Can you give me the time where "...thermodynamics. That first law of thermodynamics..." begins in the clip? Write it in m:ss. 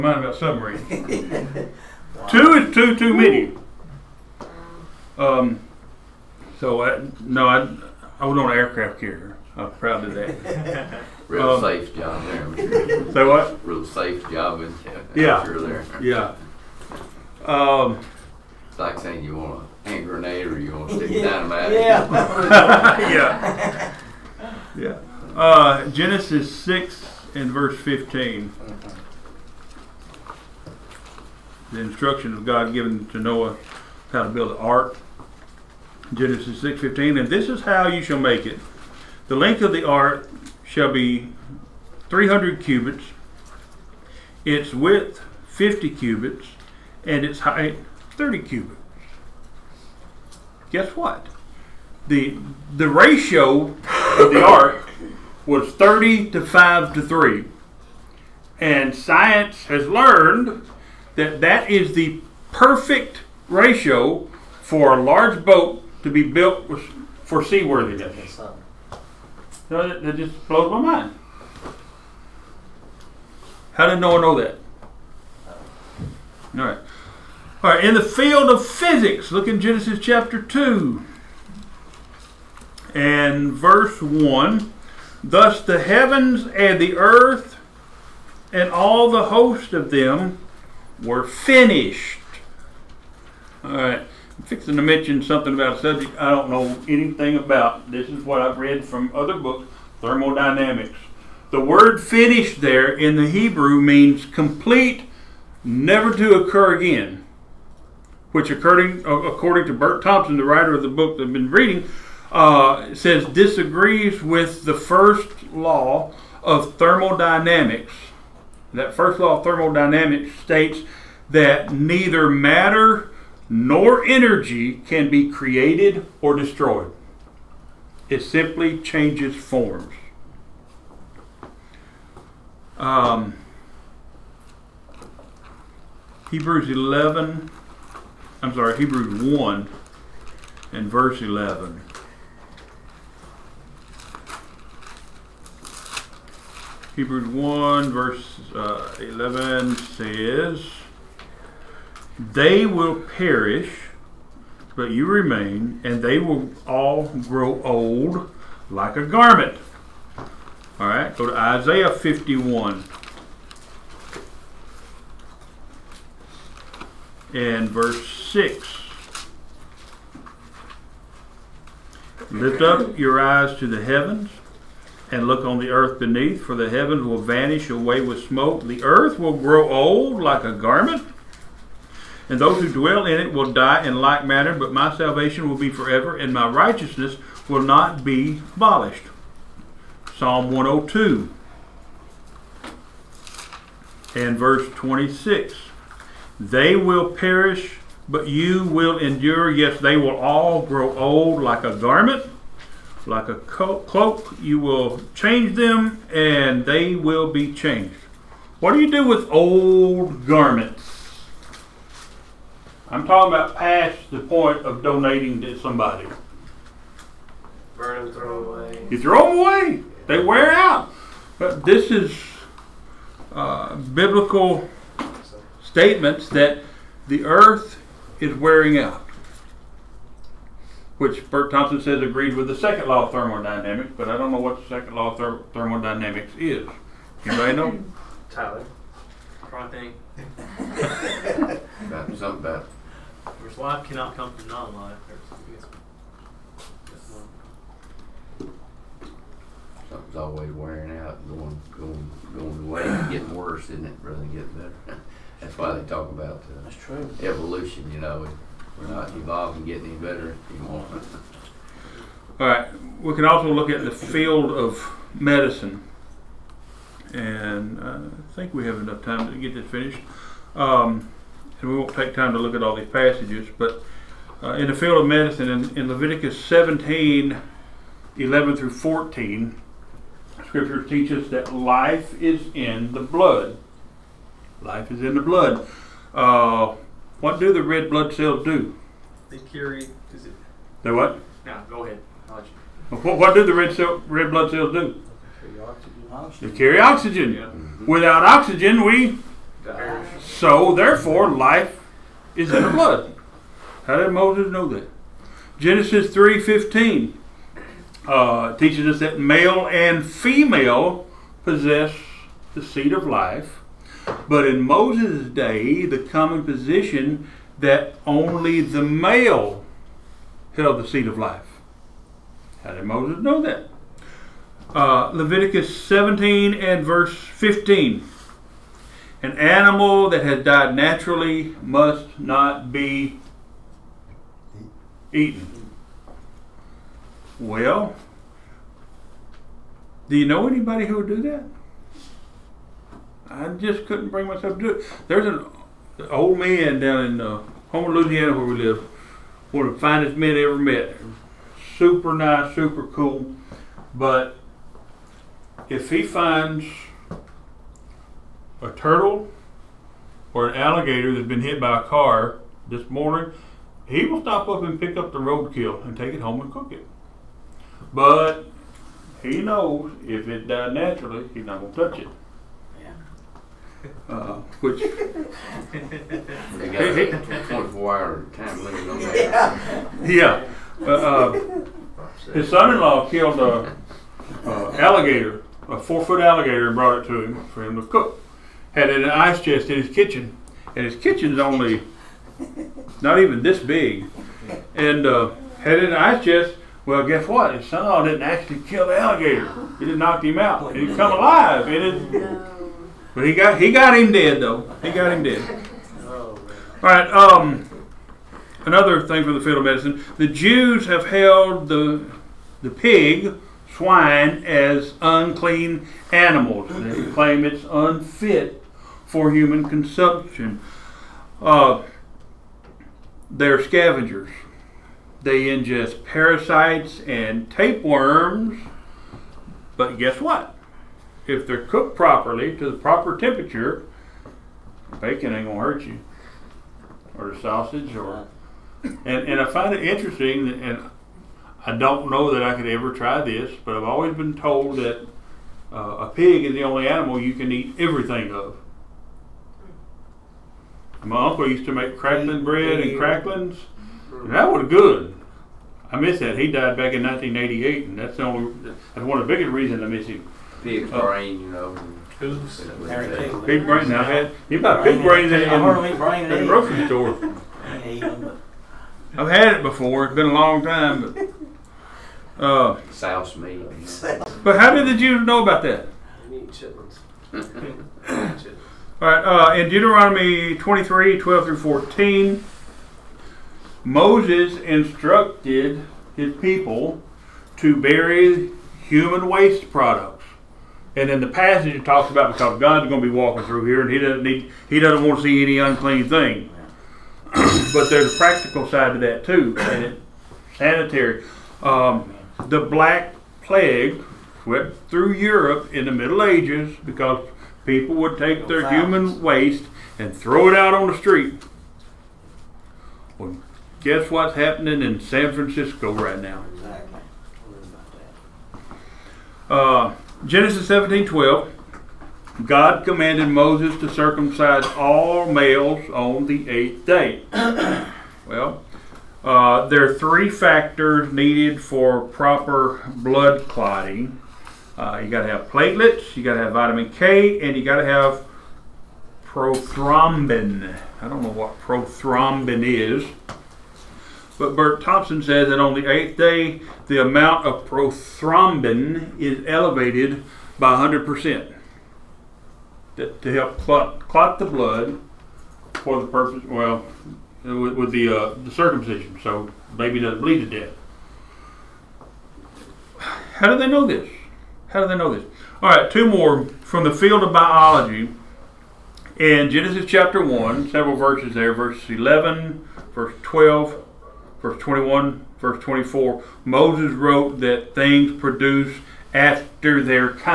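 1:56.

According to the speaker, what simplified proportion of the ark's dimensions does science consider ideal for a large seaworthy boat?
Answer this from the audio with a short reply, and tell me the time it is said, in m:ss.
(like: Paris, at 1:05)
30 to 5 to 3, at 0:55.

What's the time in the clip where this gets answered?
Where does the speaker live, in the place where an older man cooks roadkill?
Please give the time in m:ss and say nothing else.
5:47.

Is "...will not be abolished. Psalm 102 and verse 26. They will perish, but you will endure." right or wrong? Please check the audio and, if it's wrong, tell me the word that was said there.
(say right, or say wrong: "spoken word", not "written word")
right.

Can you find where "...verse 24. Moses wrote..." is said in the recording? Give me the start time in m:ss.
9:35.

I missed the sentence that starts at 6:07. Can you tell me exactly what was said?
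But he knows if it died naturally, he's not going to touch it.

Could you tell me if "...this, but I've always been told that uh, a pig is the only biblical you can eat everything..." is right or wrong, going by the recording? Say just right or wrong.
wrong.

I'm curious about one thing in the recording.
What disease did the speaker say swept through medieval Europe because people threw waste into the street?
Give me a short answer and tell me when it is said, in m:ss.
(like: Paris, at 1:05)
Black Plague, at 8:22.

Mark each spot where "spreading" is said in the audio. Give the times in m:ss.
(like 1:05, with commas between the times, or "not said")
not said.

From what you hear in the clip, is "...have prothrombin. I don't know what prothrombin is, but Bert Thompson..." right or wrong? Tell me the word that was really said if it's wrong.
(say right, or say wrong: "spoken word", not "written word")
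right.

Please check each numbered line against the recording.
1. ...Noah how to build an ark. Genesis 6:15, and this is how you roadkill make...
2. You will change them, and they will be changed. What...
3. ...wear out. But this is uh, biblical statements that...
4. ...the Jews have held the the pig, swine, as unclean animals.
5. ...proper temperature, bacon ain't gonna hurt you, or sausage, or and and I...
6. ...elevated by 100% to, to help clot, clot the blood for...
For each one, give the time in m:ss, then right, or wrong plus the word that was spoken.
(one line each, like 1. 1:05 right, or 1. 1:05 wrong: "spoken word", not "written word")
1. 0:33 wrong: "shall", not "roadkill"
2. 3:24 right
3. 3:40 right
4. 6:50 right
5. 7:12 right
6. 9:09 right.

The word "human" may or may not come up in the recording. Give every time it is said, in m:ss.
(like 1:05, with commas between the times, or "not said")
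6:59, 8:08, 8:28.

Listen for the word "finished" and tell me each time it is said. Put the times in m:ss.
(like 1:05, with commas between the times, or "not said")
1:31, 1:42, 4:29.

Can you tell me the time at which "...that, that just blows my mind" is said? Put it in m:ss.
1:09.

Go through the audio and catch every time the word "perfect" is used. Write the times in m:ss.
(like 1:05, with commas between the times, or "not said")
1:02.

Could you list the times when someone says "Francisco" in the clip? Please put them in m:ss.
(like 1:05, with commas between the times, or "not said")
8:35.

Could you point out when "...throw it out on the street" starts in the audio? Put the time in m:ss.
8:30.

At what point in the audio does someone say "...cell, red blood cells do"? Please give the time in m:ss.
4:53.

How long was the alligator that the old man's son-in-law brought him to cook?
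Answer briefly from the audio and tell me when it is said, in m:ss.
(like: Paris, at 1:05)
4 feet, at 6:25.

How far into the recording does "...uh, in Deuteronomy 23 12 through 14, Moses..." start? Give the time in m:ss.
7:59.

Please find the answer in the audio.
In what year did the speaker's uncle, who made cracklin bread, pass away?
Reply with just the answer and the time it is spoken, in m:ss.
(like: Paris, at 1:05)
1988, at 7:37.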